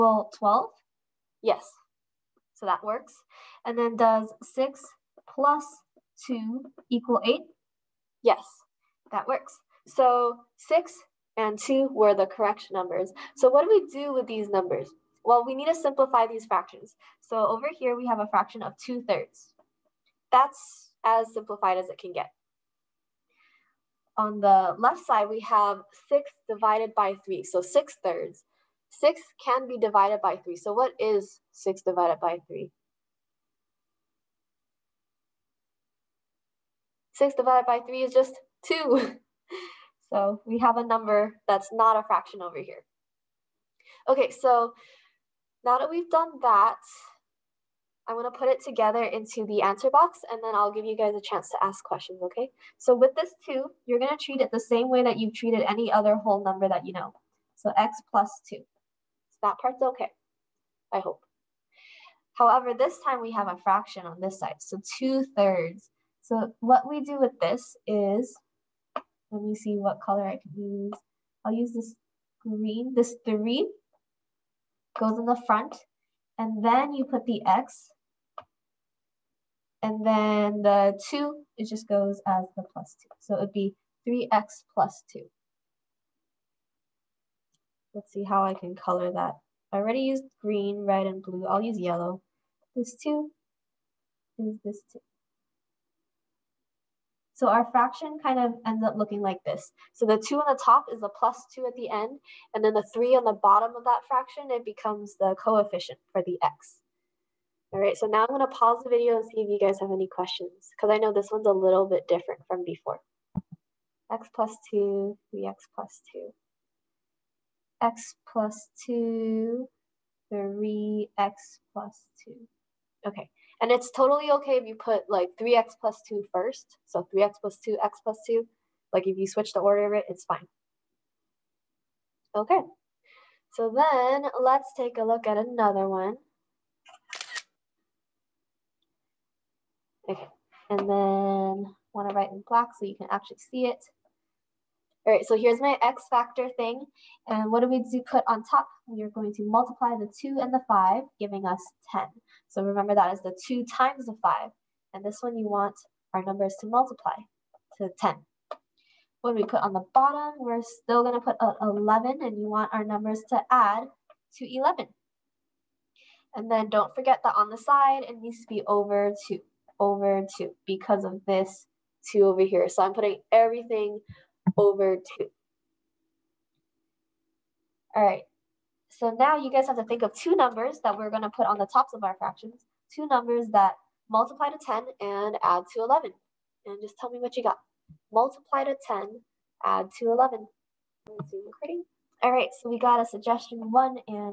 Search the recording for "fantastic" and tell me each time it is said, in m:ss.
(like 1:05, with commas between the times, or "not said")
not said.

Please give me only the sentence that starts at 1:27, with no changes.
Let's see how I can color that.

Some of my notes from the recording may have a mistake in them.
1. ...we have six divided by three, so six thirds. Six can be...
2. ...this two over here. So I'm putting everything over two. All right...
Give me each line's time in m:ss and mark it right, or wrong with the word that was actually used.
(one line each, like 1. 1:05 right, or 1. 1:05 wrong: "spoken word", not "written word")
1. 0:25 right
2. 2:51 right.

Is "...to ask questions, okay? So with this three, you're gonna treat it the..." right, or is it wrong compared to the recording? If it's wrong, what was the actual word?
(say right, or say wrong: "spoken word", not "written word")
wrong: "two", not "three".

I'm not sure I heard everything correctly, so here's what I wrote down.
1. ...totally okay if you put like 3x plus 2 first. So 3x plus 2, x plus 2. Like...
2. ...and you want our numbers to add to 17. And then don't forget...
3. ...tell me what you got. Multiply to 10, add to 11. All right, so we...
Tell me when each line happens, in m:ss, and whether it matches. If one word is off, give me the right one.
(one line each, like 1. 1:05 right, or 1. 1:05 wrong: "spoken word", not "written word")
1. 2:03 right
2. 2:42 wrong: "11", not "17"
3. 3:06 right.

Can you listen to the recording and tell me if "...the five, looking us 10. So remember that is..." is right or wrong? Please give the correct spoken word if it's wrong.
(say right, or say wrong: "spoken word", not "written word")
wrong: "giving", not "looking".